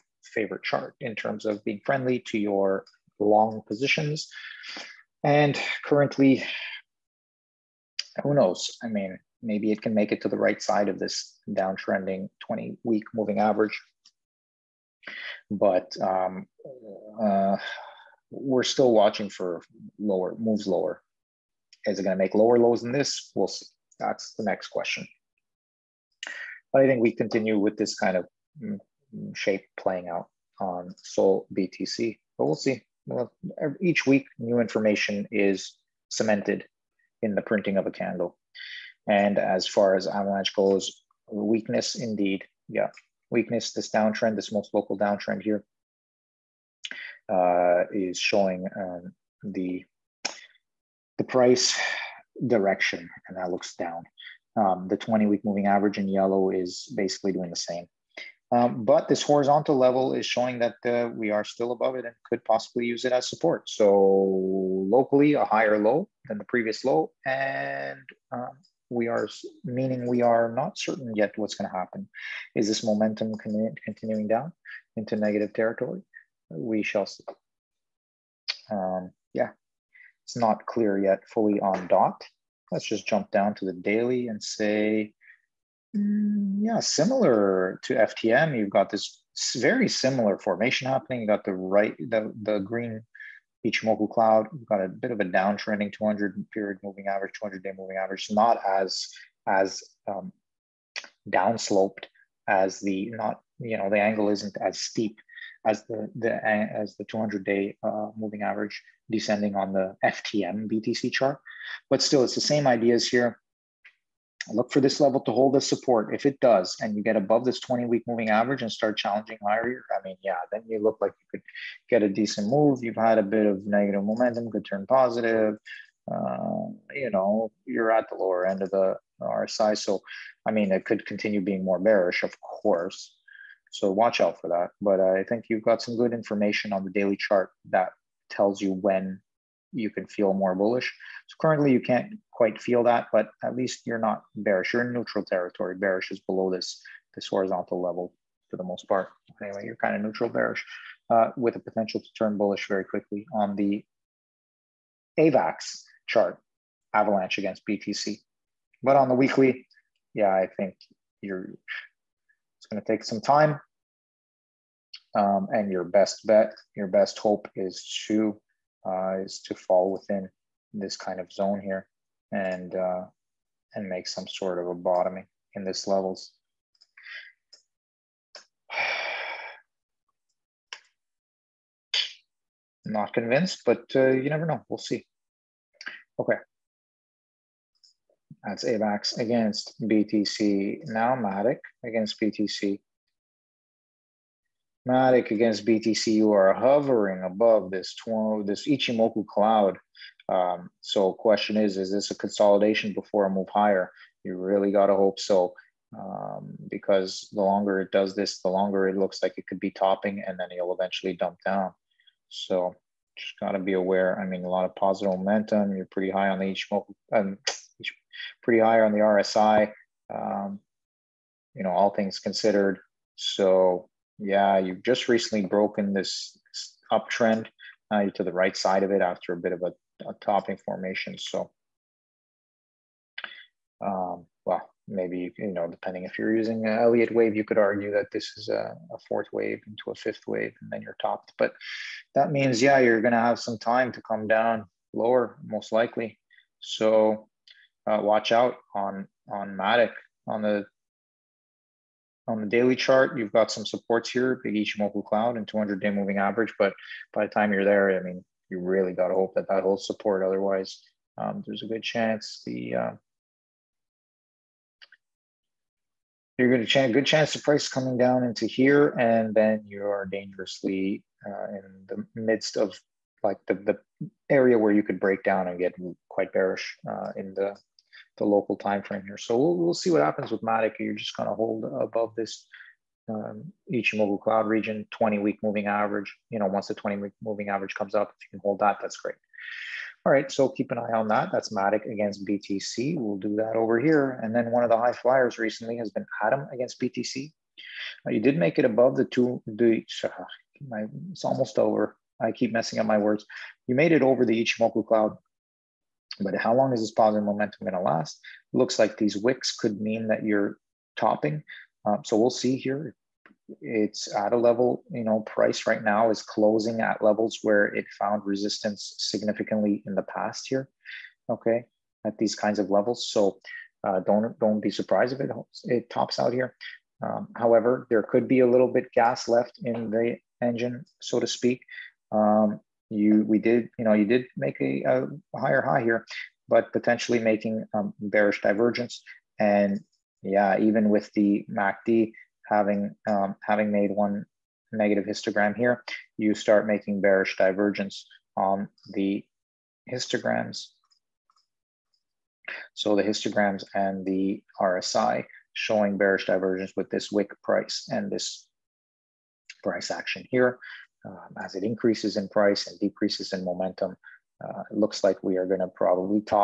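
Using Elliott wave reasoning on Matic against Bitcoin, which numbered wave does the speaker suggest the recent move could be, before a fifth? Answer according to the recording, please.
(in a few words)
Fourth wave.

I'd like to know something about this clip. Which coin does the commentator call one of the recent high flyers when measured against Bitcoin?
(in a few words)
Atom.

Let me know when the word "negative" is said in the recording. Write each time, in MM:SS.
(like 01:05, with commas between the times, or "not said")
01:15, 02:03, 05:44.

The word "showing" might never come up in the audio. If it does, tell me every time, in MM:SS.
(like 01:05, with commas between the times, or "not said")
00:48, 01:00, 05:55.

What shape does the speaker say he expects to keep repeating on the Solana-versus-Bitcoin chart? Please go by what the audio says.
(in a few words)
mm, mm.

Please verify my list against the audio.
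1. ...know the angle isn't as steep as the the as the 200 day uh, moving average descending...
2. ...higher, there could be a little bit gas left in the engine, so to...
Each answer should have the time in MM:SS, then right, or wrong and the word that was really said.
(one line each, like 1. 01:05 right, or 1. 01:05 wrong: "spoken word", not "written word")
1. 01:43 right
2. 05:27 wrong: "however", not "higher".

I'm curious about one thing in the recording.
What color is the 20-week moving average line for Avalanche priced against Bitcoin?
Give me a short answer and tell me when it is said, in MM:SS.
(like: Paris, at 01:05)
Yellow, at 00:56.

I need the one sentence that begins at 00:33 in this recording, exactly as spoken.
Well, each week, new information is cemented in the printing of a candle.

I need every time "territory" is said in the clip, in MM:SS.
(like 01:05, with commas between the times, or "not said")
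01:15, 02:25.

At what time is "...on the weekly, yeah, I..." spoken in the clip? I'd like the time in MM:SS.
02:38.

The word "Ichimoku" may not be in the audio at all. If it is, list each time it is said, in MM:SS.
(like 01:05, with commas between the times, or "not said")
01:33, 03:18, 03:36, 04:14, 04:43, 05:04.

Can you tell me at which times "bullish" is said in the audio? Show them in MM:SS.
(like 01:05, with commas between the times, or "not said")
02:20, 02:32.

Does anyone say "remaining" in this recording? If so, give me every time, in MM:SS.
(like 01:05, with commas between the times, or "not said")
not said.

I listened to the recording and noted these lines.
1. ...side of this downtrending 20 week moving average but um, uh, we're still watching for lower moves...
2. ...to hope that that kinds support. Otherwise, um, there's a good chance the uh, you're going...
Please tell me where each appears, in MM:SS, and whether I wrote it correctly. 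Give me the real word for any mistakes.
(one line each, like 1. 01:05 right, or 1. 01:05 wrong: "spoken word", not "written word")
1. 00:10 right
2. 04:19 wrong: "holds", not "kinds".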